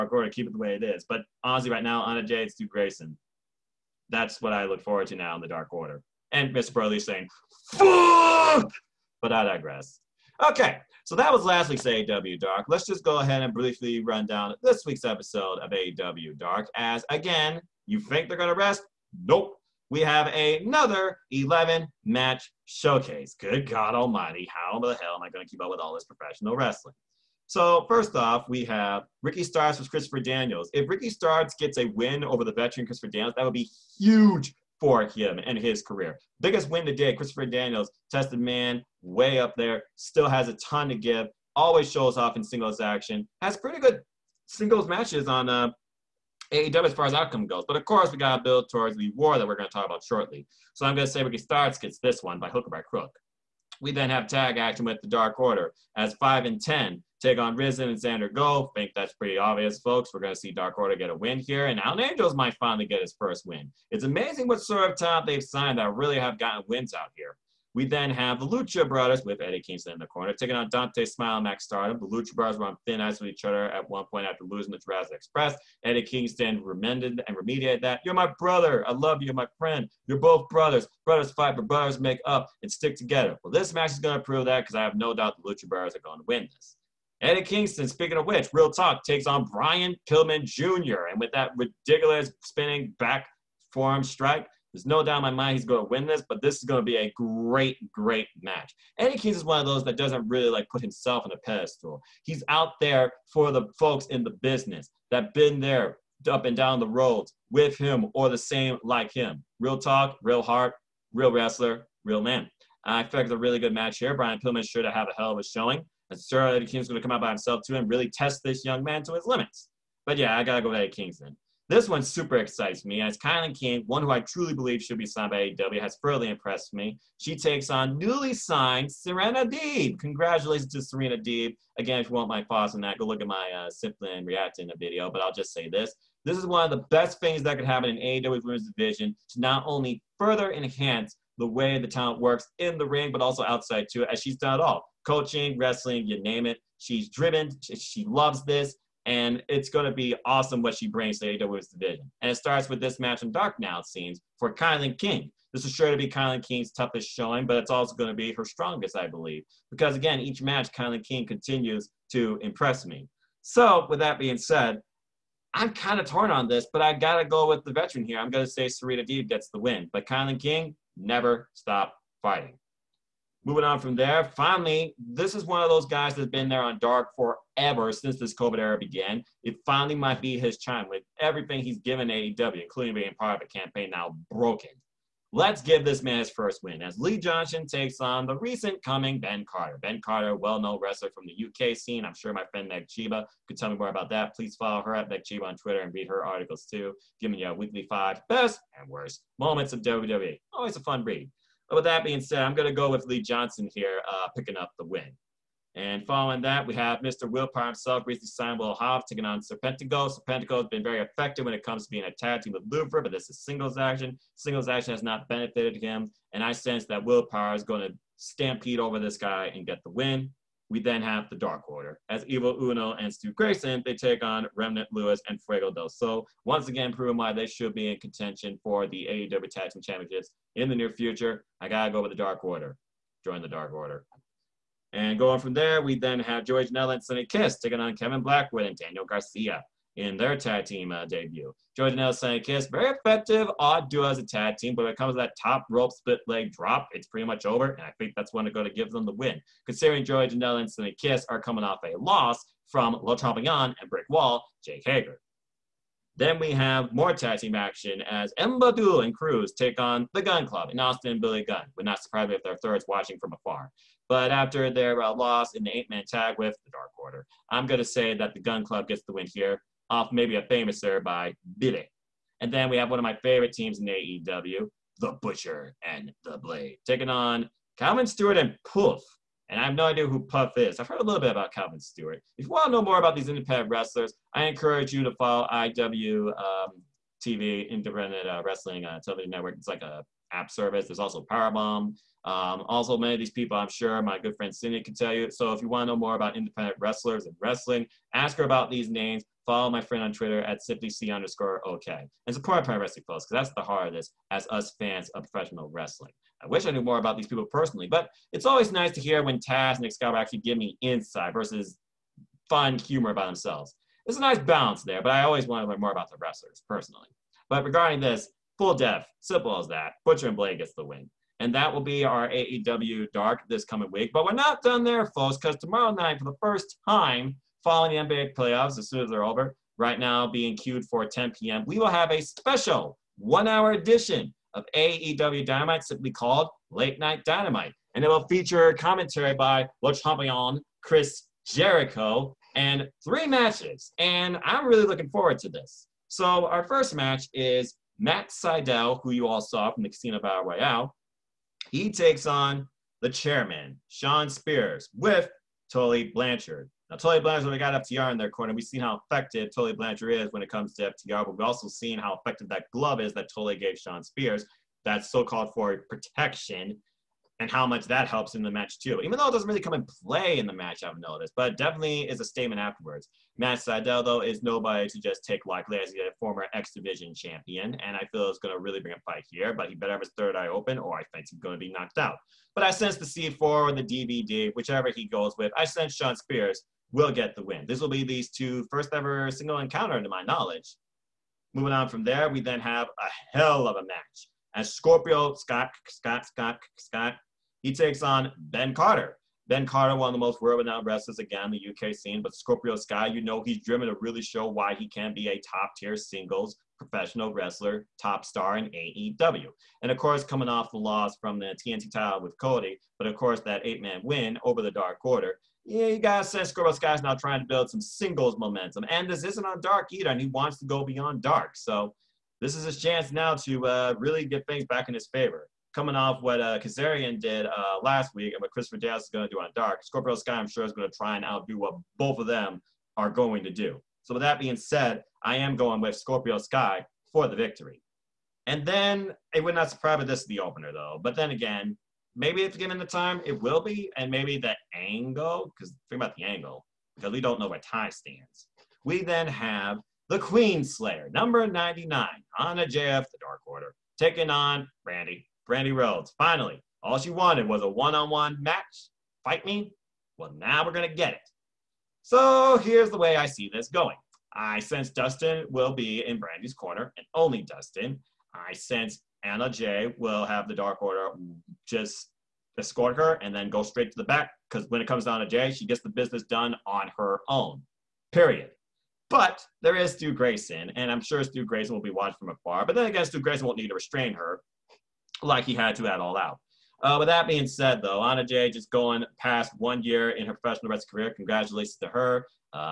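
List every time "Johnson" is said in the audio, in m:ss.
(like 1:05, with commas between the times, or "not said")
3:07, 3:23.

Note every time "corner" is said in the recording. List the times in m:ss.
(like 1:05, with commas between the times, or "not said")
1:10, 5:58, 7:46.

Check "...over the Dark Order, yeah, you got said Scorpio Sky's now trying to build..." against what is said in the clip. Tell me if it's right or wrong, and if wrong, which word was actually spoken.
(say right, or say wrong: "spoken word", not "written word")
right.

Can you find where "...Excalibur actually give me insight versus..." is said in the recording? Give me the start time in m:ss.
5:09.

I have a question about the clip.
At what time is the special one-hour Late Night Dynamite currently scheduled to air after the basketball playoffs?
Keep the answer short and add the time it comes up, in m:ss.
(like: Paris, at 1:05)
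10 p.m., at 5:31.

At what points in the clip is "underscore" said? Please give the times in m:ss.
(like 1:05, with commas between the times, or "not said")
5:01.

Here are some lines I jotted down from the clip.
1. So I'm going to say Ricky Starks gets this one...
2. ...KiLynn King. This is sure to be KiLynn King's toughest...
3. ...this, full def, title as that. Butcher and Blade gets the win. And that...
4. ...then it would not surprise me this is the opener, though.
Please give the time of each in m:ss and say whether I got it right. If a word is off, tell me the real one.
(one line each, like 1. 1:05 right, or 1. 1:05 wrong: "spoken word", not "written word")
1. 0:50 right
2. 2:34 right
3. 5:17 wrong: "simple", not "title"
4. 7:18 right.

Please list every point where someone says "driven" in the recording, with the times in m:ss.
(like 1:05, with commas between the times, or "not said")
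2:27, 6:43.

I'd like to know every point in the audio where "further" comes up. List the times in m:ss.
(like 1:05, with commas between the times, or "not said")
2:05, 2:20.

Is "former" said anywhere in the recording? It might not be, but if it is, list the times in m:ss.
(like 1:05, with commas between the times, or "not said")
6:16.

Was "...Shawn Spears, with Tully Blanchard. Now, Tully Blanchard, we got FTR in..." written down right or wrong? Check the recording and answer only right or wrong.
right.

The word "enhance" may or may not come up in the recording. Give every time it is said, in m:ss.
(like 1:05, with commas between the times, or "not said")
2:20.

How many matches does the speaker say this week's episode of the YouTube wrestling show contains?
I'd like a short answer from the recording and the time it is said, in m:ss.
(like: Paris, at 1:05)
11, at 0:21.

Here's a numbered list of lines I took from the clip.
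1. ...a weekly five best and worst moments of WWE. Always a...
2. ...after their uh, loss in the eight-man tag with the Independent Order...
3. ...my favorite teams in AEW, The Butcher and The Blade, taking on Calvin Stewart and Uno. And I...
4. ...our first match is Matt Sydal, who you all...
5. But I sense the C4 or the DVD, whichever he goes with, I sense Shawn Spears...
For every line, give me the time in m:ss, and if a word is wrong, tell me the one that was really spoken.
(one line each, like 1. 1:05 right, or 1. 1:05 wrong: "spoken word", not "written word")
1. 3:17 right
2. 4:24 wrong: "Dark", not "Independent"
3. 4:33 wrong: "Puff", not "Uno"
4. 5:46 right
5. 6:22 right.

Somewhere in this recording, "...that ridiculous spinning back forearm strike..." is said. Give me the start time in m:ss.
1:31.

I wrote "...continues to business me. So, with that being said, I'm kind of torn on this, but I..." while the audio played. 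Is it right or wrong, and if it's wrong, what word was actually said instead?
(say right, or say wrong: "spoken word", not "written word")
wrong: "impress", not "business".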